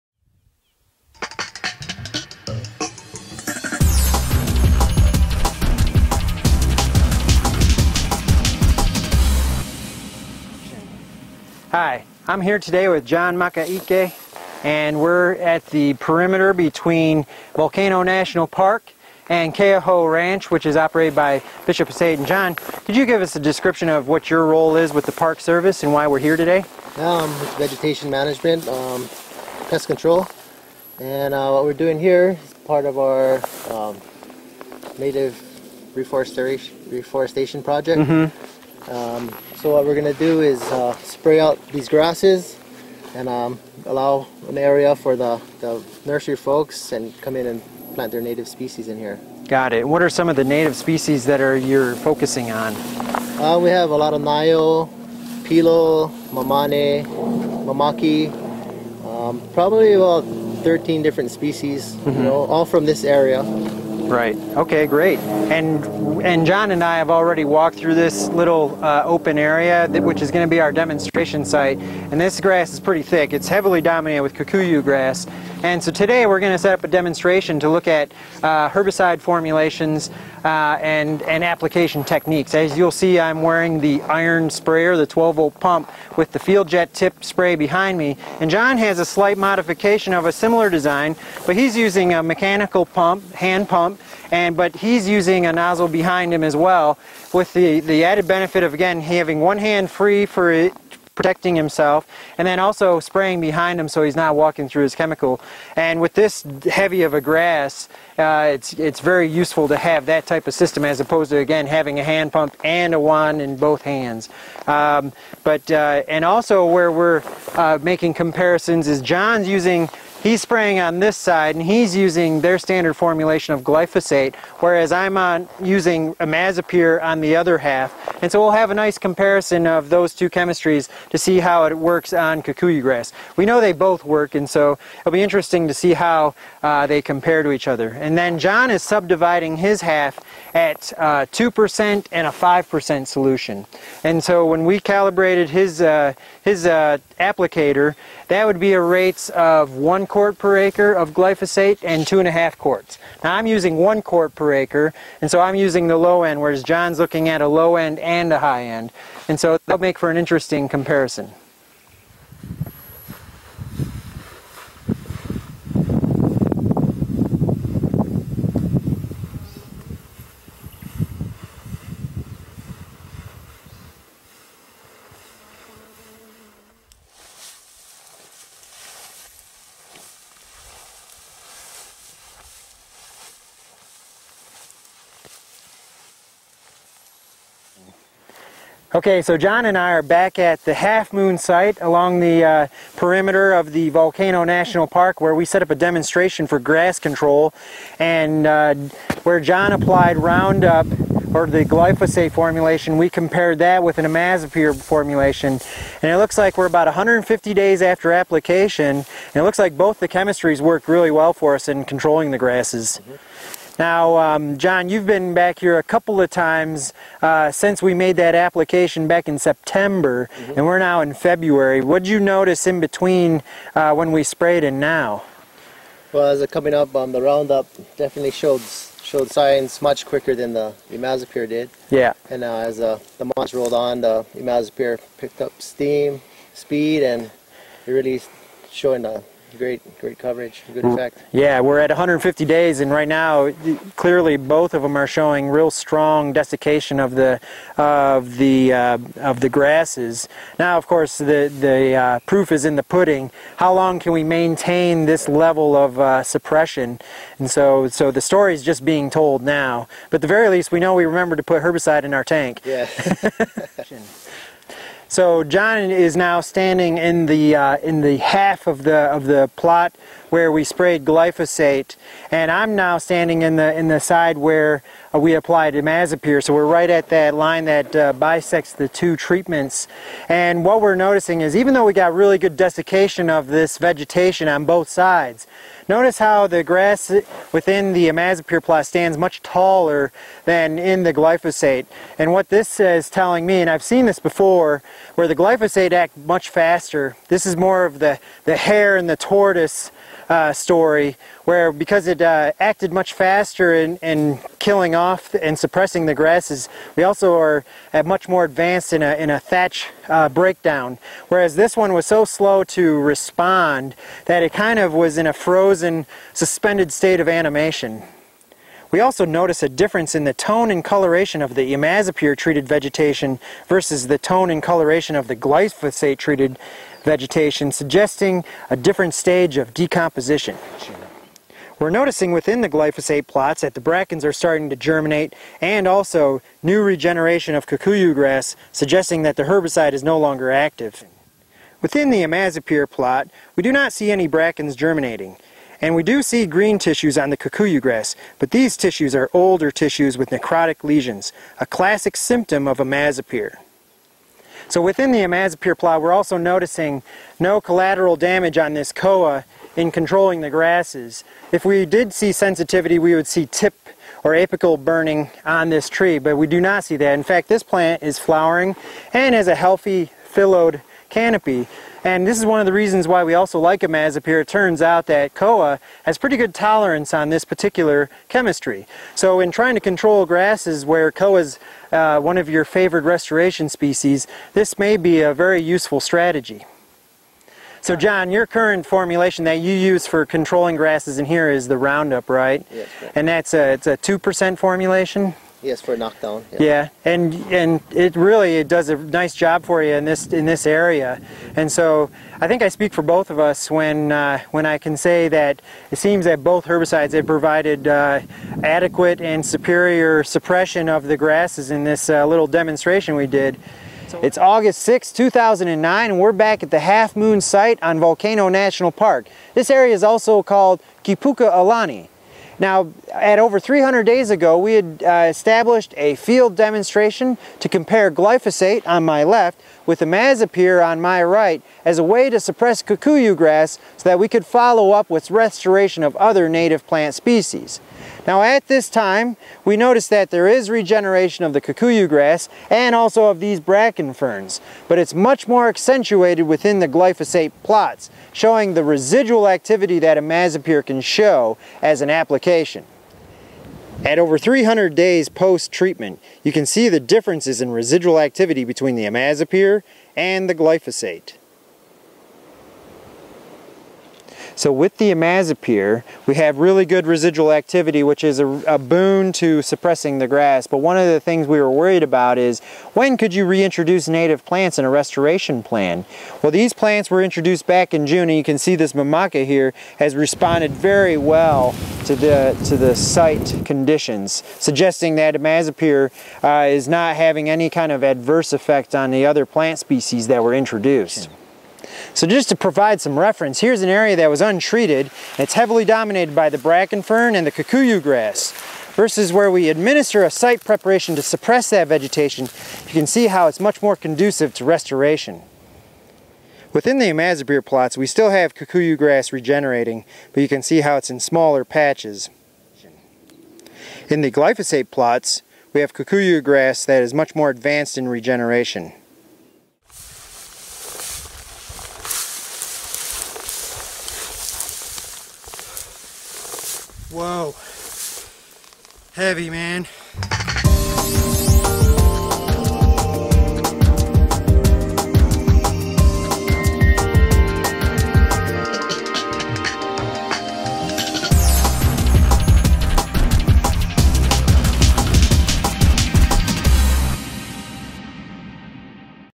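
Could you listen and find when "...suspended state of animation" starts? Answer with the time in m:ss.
5:16.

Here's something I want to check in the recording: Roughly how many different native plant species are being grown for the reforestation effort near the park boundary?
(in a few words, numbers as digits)
13.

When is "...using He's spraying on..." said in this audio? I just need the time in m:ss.
1:59.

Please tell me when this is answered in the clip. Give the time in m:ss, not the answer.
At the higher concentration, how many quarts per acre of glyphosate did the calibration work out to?
2:32.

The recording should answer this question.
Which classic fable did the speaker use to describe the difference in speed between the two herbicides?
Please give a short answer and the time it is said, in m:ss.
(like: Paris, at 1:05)
the hare and the tortoise, at 4:58.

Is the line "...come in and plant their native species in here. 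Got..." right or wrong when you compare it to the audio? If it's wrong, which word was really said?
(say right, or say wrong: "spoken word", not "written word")
right.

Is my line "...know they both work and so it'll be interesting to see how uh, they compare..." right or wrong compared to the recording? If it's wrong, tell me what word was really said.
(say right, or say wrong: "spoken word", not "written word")
right.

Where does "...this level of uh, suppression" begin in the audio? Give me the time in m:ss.
4:15.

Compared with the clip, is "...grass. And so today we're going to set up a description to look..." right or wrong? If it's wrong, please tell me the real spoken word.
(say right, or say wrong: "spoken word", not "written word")
wrong: "demonstration", not "description".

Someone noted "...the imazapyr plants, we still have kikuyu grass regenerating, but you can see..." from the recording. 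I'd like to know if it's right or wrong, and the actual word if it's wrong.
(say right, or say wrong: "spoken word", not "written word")
wrong: "plots", not "plants".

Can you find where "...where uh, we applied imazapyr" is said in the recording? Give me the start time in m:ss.
4:34.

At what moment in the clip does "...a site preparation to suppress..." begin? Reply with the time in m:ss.
8:20.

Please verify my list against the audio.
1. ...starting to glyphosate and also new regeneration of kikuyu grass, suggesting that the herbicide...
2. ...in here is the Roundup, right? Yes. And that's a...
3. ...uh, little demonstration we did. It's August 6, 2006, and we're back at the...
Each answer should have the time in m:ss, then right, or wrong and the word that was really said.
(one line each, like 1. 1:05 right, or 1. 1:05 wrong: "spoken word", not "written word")
1. 5:34 wrong: "germinate", not "glyphosate"
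2. 6:31 right
3. 6:52 wrong: "2009", not "2006".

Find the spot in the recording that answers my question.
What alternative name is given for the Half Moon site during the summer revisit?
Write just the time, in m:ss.
7:01.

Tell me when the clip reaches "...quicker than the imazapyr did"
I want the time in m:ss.
3:50.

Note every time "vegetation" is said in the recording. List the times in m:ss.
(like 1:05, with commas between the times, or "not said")
0:27, 4:43, 5:22, 5:27, 8:21.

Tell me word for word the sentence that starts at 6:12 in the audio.
And this is one of the reasons why we also like imazapyr.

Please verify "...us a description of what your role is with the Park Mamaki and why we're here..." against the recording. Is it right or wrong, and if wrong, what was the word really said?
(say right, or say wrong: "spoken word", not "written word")
wrong: "Service", not "Mamaki".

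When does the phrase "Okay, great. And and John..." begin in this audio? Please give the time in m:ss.
1:04.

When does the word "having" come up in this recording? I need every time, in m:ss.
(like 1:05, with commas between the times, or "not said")
1:39, 1:51, 8:07.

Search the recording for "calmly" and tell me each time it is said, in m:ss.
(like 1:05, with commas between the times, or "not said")
not said.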